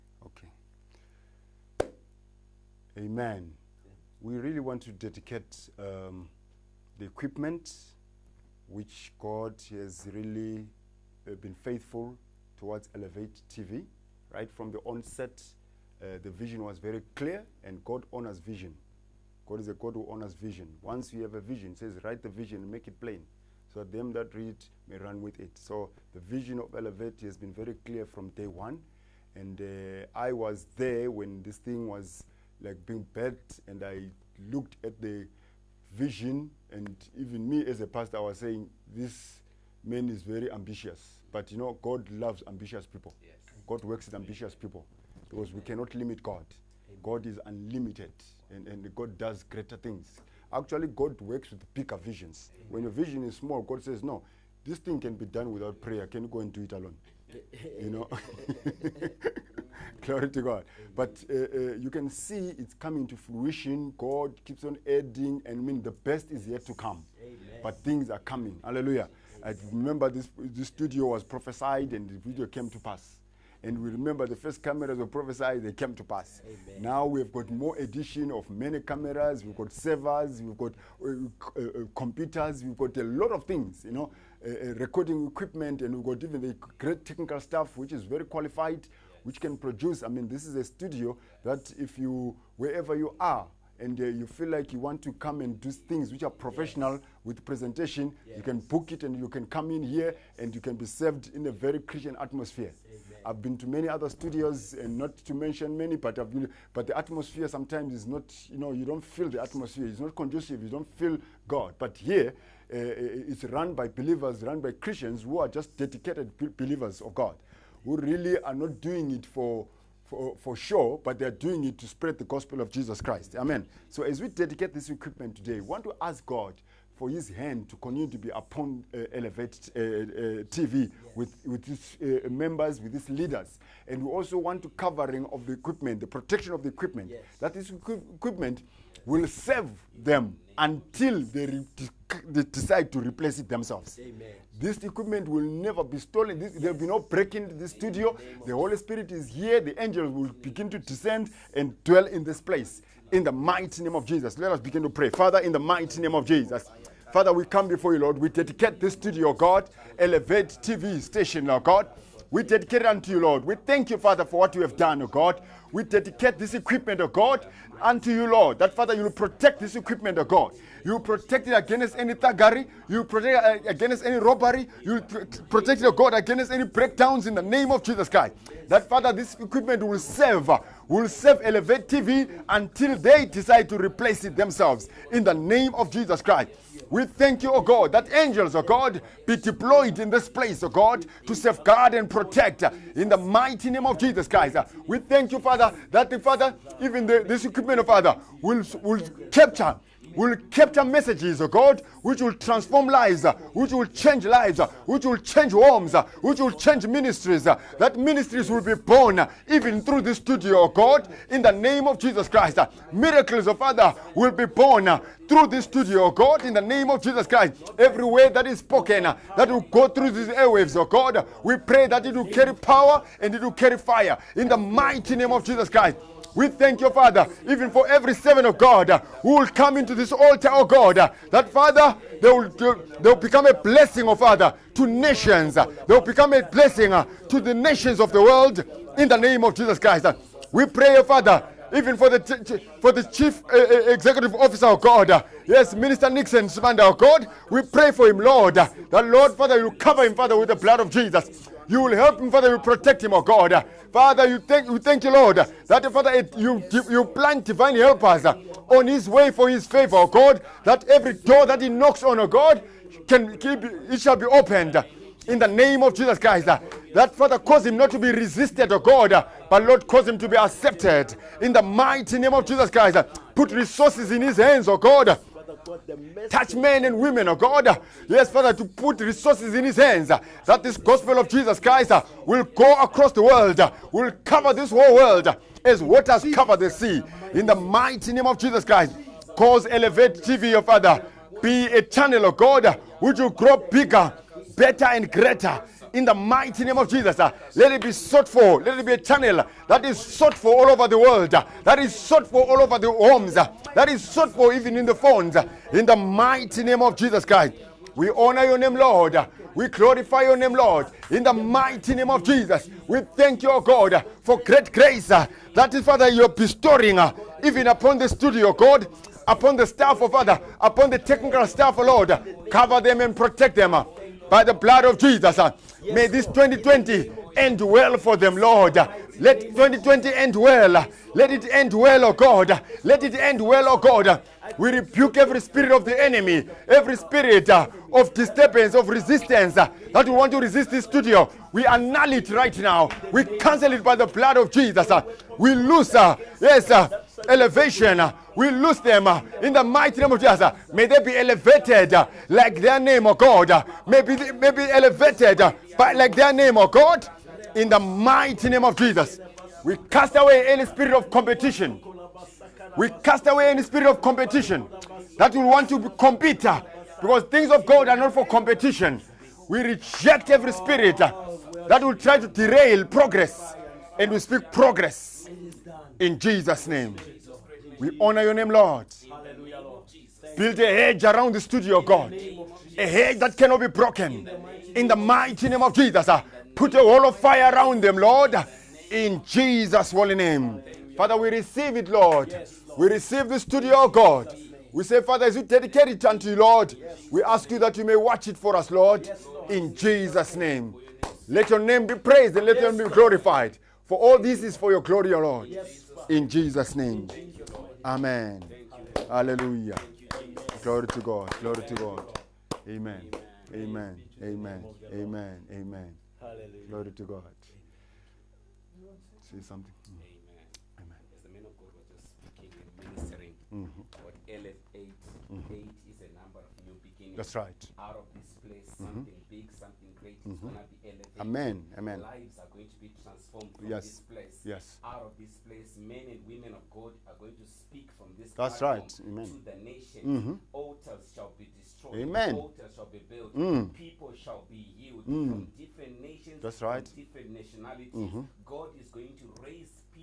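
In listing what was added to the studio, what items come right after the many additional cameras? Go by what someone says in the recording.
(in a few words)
servers.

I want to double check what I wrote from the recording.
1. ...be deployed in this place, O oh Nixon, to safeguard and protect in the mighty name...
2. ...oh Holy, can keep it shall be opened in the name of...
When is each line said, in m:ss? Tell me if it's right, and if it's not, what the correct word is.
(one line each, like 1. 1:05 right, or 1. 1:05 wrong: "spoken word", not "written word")
1. 3:09 wrong: "God", not "Nixon"
2. 4:22 wrong: "God", not "Holy".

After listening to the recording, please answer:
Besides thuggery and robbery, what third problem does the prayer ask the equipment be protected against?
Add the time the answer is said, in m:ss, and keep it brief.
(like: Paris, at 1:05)
breakdowns, at 2:56.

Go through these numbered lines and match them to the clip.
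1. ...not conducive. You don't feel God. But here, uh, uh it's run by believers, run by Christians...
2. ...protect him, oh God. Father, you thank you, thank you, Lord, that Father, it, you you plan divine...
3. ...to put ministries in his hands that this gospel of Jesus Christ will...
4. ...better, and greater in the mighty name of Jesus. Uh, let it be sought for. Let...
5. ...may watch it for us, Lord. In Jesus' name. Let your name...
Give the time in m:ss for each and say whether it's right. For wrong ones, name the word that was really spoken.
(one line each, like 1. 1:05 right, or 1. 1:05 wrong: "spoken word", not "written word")
1. 1:49 right
2. 4:12 right
3. 4:38 wrong: "resources", not "ministries"
4. 4:54 right
5. 6:37 right.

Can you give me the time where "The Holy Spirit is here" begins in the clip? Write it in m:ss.
2:28.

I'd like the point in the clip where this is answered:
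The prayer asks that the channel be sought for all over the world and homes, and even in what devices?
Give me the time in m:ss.
5:04.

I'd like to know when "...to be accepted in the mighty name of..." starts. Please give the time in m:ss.
4:30.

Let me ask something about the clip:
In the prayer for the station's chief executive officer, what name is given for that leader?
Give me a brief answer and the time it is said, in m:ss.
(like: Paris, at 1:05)
Nixon Sumanda, at 4:06.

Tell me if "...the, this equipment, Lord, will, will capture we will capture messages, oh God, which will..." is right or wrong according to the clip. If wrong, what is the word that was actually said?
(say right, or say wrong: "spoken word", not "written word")
wrong: "Father", not "Lord".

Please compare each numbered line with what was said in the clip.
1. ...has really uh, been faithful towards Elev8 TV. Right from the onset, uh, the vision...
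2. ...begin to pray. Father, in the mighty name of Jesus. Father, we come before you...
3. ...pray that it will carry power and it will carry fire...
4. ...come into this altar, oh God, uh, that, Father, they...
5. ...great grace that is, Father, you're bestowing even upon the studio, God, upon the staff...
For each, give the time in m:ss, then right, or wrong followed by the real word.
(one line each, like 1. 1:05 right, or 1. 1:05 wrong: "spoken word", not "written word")
1. 0:09 right
2. 2:34 right
3. 3:41 right
4. 3:49 right
5. 5:14 right.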